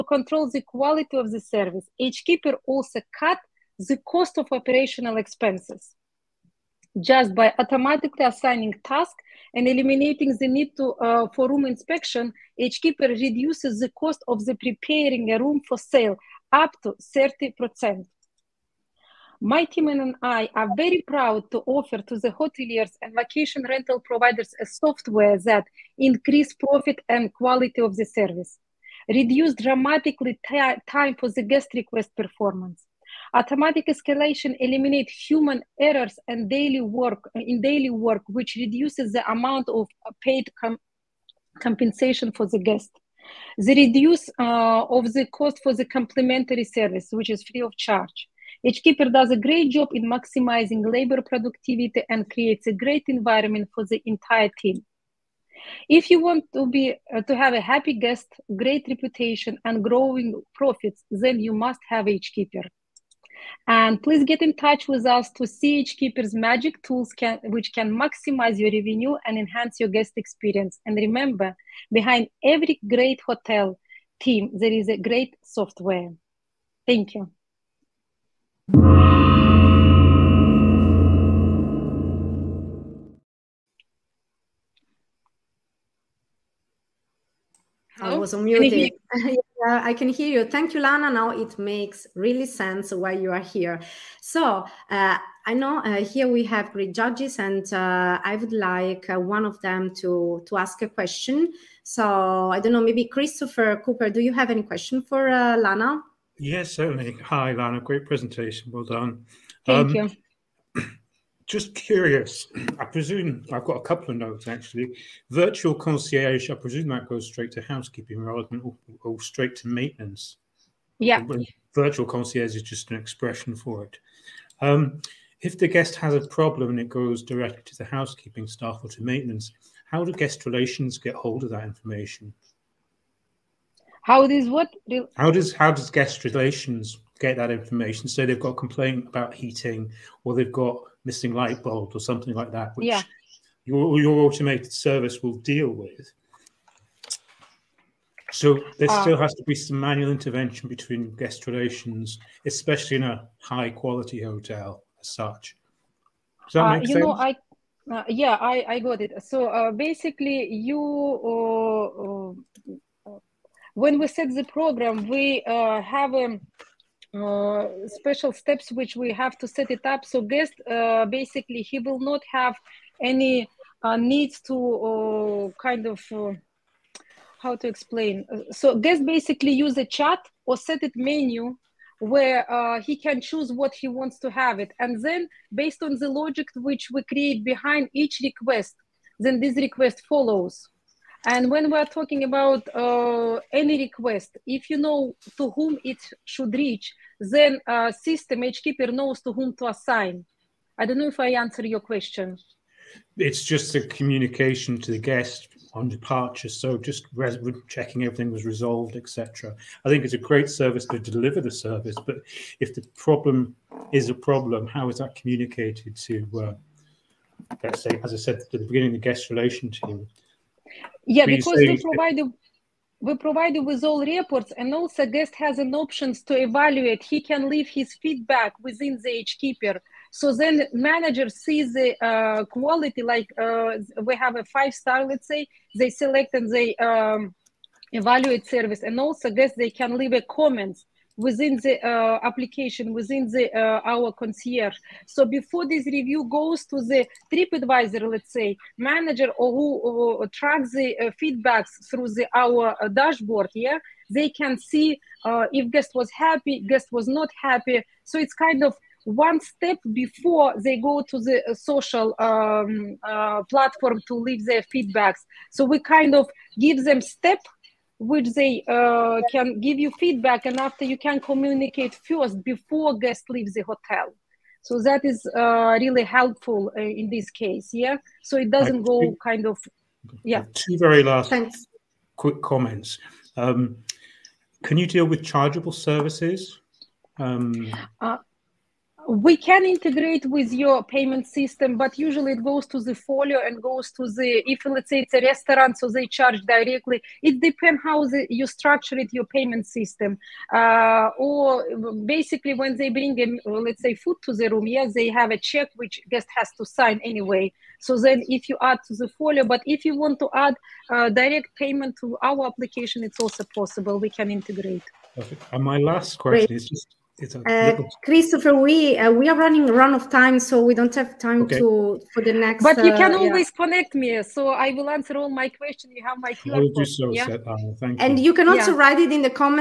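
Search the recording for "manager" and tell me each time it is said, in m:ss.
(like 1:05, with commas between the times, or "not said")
3:50, 4:08.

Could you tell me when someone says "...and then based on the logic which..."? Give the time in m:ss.
3:04.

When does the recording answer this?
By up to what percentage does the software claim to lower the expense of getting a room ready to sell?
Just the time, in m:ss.
0:17.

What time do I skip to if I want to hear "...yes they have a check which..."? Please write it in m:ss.
5:04.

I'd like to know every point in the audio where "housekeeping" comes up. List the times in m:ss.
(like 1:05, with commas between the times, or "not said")
1:57, 2:07.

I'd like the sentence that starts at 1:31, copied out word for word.
Now it makes really sense why you are here.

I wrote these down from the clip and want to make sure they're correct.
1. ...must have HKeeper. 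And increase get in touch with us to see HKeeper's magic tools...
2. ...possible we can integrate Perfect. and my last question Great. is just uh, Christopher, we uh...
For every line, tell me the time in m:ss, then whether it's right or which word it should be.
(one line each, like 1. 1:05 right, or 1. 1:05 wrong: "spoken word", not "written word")
1. 1:01 wrong: "please", not "increase"
2. 5:13 right.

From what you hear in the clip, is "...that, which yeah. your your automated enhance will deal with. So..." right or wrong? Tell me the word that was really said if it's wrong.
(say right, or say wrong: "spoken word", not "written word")
wrong: "service", not "enhance".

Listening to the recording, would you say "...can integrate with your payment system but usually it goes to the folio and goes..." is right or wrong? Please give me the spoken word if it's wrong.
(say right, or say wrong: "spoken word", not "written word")
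right.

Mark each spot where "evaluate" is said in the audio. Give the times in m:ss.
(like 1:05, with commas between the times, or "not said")
3:46, 3:57.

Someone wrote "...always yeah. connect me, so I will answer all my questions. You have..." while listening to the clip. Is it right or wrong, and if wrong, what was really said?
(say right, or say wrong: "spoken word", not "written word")
right.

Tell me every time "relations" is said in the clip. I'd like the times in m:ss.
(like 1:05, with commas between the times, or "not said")
2:10, 2:16, 2:31, 3:39.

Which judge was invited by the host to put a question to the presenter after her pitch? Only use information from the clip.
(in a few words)
Christopher Cooper.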